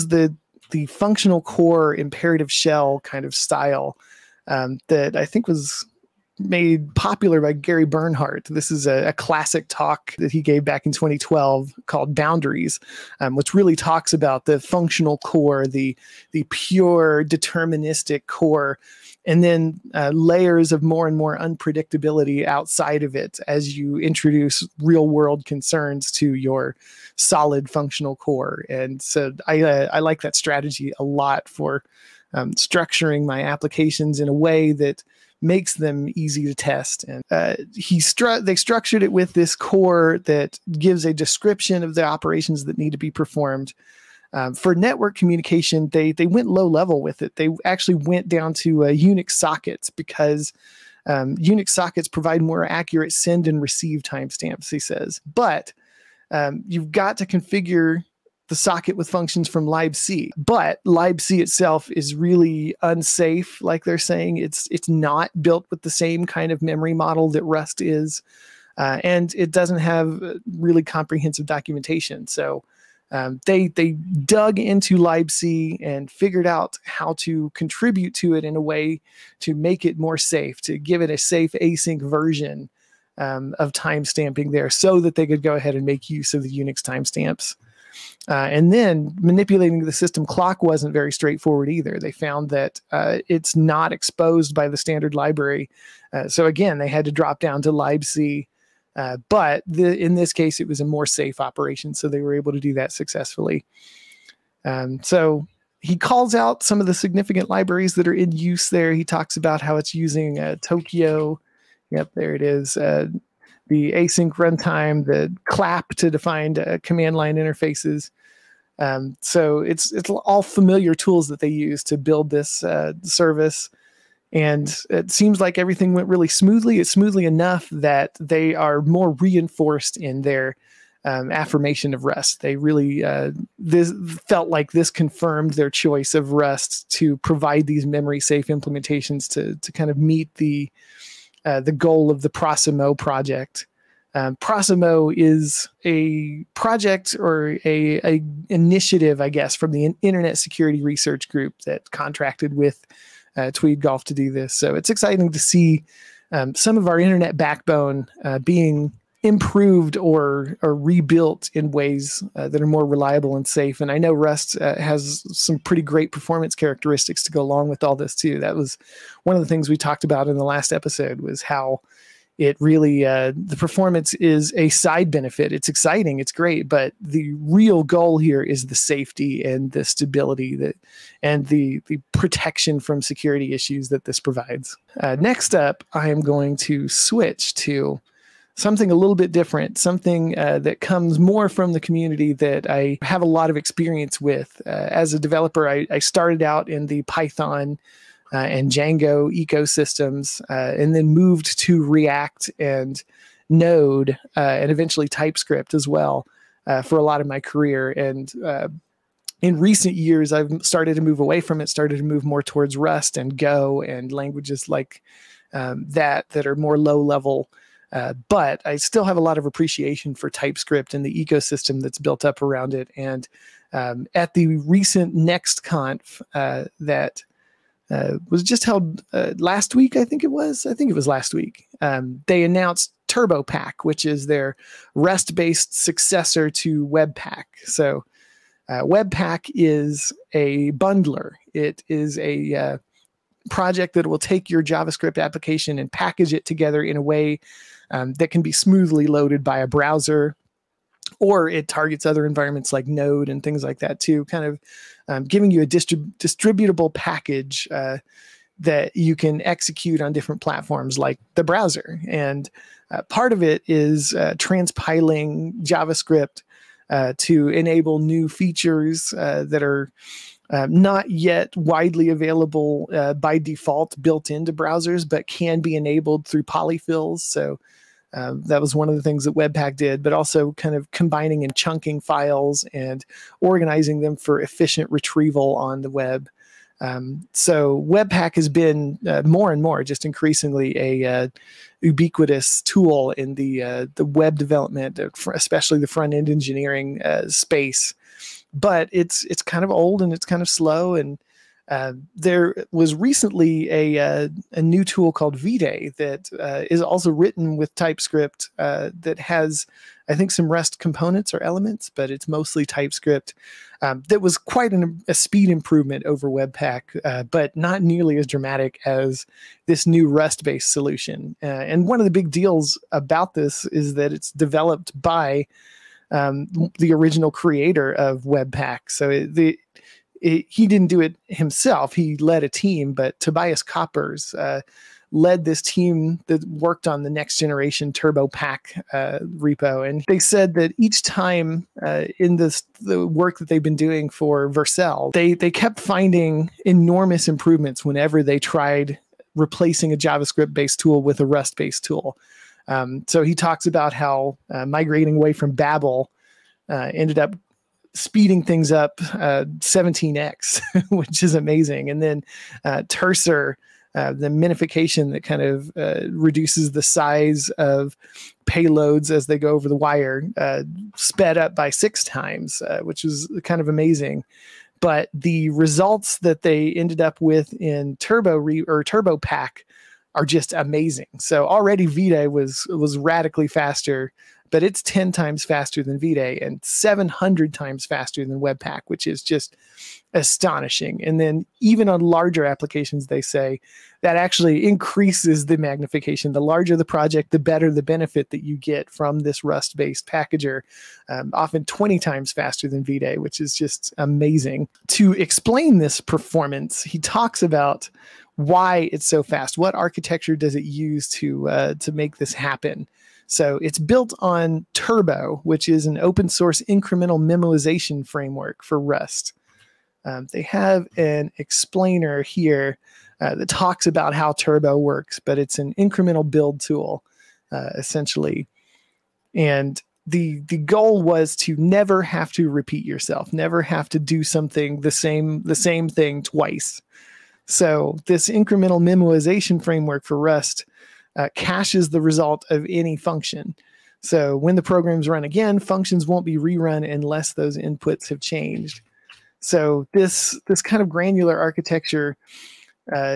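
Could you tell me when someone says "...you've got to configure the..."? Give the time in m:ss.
0:56.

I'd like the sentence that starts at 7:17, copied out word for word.
So this incremental memoization framework for Rust uh, caches the result of any function.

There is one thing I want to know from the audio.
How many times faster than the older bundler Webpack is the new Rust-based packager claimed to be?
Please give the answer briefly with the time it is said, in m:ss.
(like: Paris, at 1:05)
700, at 6:26.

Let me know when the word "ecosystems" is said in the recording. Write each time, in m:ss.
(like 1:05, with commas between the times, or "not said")
3:19, 3:41.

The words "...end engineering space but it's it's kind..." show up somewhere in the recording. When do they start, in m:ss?
4:56.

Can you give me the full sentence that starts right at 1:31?
They found that uh, it's not exposed by the standard library.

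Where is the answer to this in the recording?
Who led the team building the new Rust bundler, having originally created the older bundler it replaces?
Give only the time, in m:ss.
5:33.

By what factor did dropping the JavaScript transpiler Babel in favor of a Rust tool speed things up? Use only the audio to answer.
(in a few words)
17x.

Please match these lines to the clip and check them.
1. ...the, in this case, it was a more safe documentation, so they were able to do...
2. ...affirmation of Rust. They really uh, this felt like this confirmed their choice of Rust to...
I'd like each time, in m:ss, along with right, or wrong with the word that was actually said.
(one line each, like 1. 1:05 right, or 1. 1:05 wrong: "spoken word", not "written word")
1. 1:39 wrong: "operation", not "documentation"
2. 2:11 right.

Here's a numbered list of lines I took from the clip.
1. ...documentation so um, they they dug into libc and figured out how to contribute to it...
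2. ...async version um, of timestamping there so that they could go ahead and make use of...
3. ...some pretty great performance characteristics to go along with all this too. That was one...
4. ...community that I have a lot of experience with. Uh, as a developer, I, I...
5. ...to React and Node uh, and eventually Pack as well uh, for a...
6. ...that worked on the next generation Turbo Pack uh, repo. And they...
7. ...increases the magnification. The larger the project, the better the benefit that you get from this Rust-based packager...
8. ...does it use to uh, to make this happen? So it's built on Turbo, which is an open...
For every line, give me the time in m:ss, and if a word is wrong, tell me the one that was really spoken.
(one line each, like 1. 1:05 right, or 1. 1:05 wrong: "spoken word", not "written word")
1. 1:11 right
2. 1:21 right
3. 2:45 right
4. 3:11 right
5. 3:21 wrong: "TypeScript", not "Pack"
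6. 5:36 right
7. 6:34 right
8. 6:50 right.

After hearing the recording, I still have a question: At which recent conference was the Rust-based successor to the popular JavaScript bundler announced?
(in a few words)
NextConf.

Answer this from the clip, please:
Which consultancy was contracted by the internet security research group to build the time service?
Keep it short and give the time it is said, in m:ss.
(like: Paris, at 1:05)
Tweed Golf, at 2:33.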